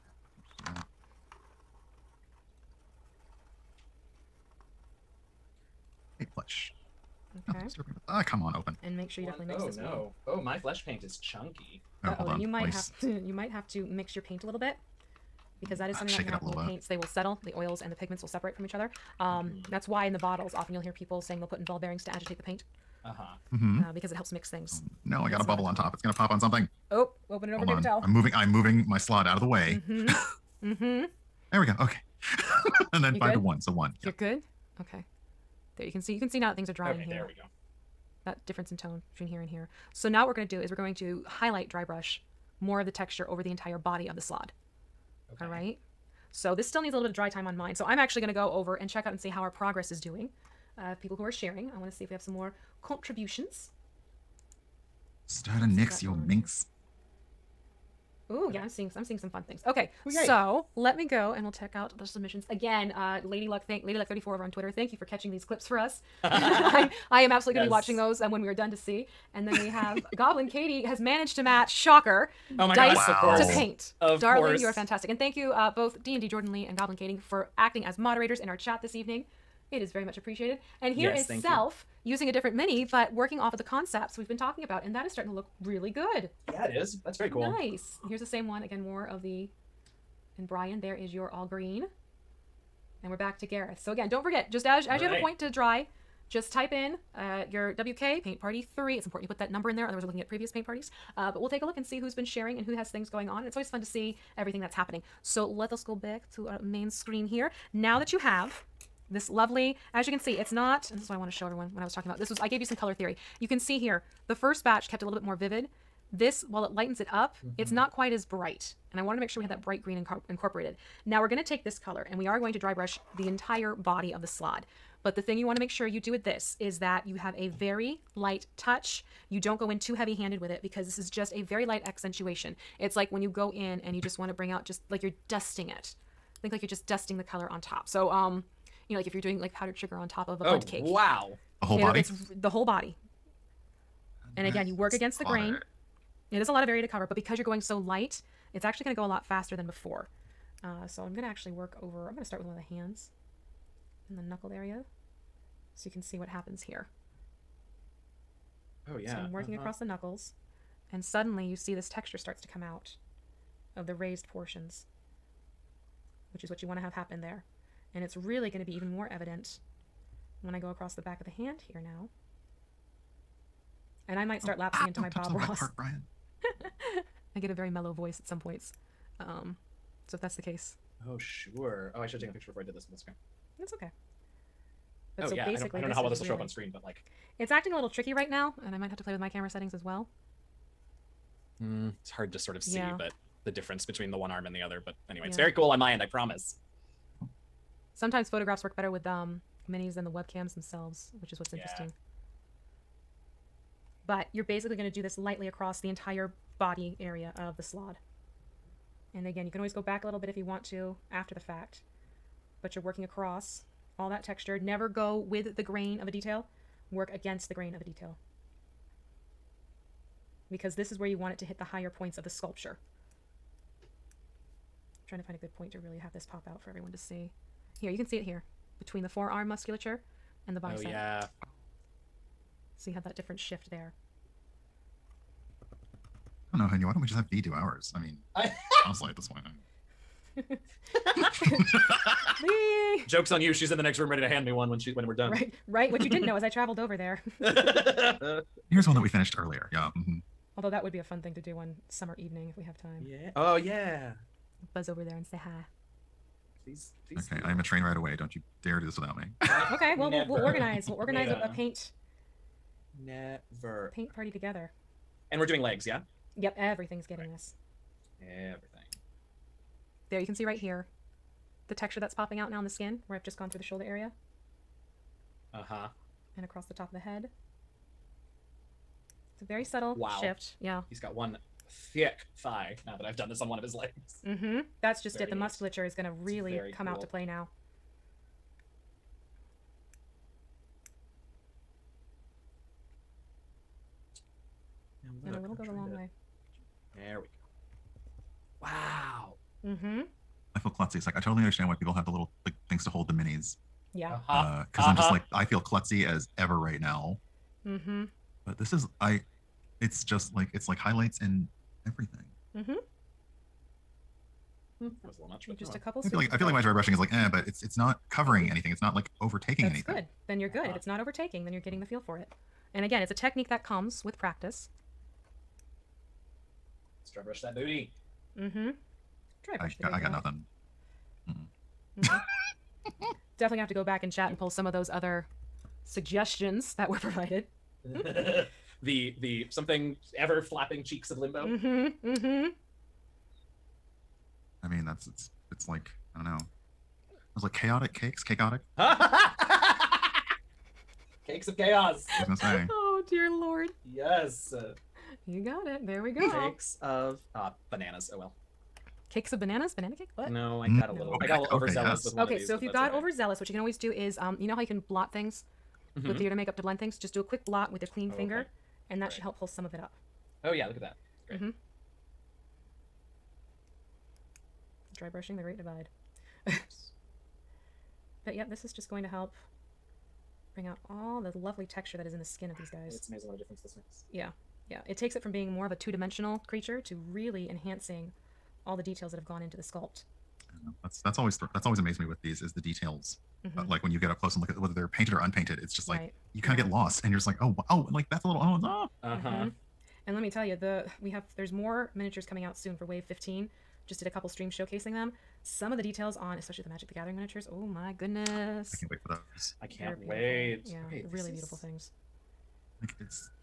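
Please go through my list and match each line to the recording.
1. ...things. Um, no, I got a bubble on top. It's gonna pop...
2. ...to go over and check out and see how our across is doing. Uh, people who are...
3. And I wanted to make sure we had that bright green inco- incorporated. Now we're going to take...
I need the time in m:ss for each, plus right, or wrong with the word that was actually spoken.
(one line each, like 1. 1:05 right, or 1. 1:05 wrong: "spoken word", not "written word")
1. 0:24 right
2. 0:48 wrong: "progress", not "across"
3. 1:58 right.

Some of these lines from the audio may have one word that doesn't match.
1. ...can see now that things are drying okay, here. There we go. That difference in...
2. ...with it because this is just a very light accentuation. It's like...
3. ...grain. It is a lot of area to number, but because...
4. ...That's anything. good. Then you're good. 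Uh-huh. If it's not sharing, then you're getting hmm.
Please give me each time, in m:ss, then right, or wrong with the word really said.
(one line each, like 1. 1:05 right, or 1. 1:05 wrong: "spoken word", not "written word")
1. 0:36 right
2. 2:10 right
3. 2:25 wrong: "cover", not "number"
4. 5:19 wrong: "overtaking", not "sharing".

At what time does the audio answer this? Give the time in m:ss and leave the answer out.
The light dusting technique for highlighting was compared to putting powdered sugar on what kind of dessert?
2:20.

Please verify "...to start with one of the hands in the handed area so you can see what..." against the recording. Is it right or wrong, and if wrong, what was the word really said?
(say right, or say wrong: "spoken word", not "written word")
wrong: "knuckled", not "handed".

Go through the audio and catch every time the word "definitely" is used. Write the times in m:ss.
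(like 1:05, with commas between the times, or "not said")
0:09, 5:33.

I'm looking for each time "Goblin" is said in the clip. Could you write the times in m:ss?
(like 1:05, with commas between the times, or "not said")
1:10, 1:16.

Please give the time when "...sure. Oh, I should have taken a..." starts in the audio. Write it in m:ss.
3:01.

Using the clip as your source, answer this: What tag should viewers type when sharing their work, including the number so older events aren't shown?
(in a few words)
WK paint party 3.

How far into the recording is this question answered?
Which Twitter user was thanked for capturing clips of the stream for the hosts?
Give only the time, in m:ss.
1:03.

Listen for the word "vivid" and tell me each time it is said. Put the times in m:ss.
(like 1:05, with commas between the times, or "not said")
1:55.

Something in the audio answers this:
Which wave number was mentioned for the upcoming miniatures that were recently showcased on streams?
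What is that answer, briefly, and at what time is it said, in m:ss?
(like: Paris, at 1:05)
15, at 6:42.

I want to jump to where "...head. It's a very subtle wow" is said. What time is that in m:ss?
4:36.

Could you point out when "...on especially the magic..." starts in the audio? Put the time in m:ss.
6:46.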